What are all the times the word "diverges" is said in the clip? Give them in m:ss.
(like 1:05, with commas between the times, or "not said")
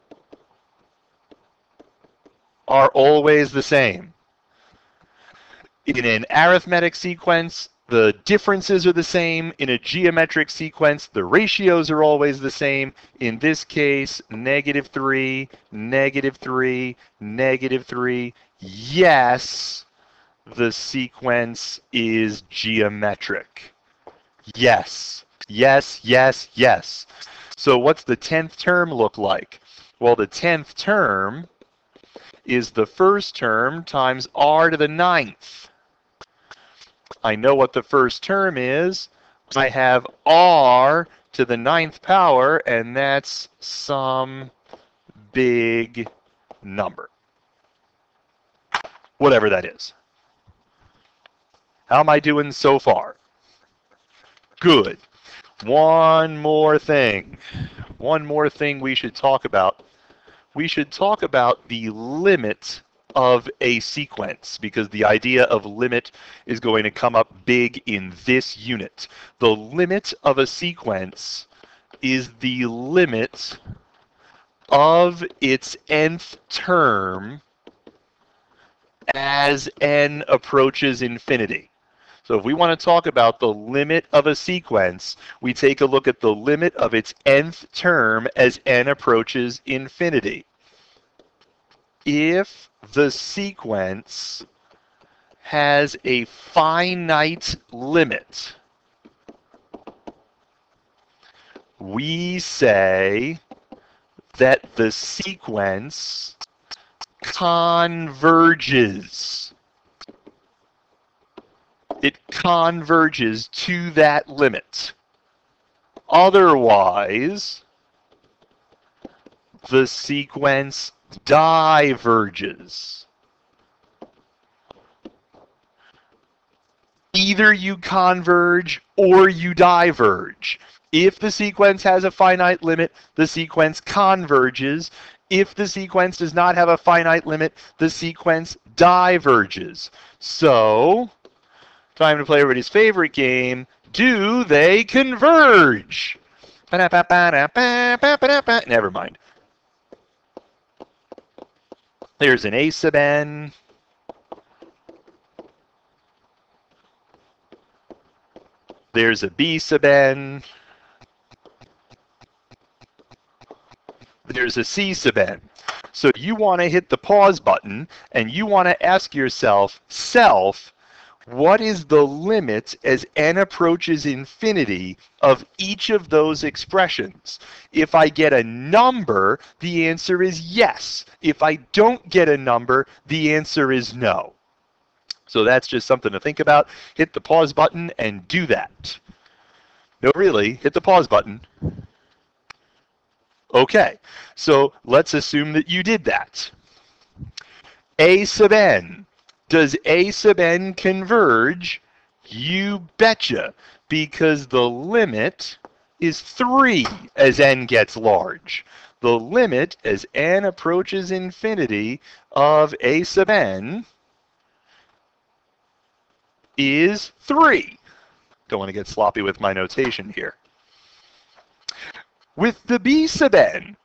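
2:01, 2:09, 2:18.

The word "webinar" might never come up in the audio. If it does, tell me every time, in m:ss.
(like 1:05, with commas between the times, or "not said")
not said.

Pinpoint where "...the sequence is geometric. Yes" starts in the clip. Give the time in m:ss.
0:20.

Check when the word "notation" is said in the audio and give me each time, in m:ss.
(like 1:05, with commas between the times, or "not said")
3:39.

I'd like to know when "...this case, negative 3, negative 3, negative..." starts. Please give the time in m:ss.
0:13.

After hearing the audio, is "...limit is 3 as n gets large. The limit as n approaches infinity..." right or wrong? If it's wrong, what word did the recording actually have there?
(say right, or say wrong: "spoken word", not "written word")
right.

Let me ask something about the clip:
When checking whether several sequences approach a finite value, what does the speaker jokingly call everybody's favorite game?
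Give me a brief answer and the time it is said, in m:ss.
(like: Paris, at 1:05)
Do they converge?, at 2:23.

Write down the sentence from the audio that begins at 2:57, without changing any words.
If I get a number, the answer is yes.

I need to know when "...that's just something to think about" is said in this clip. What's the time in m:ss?
3:05.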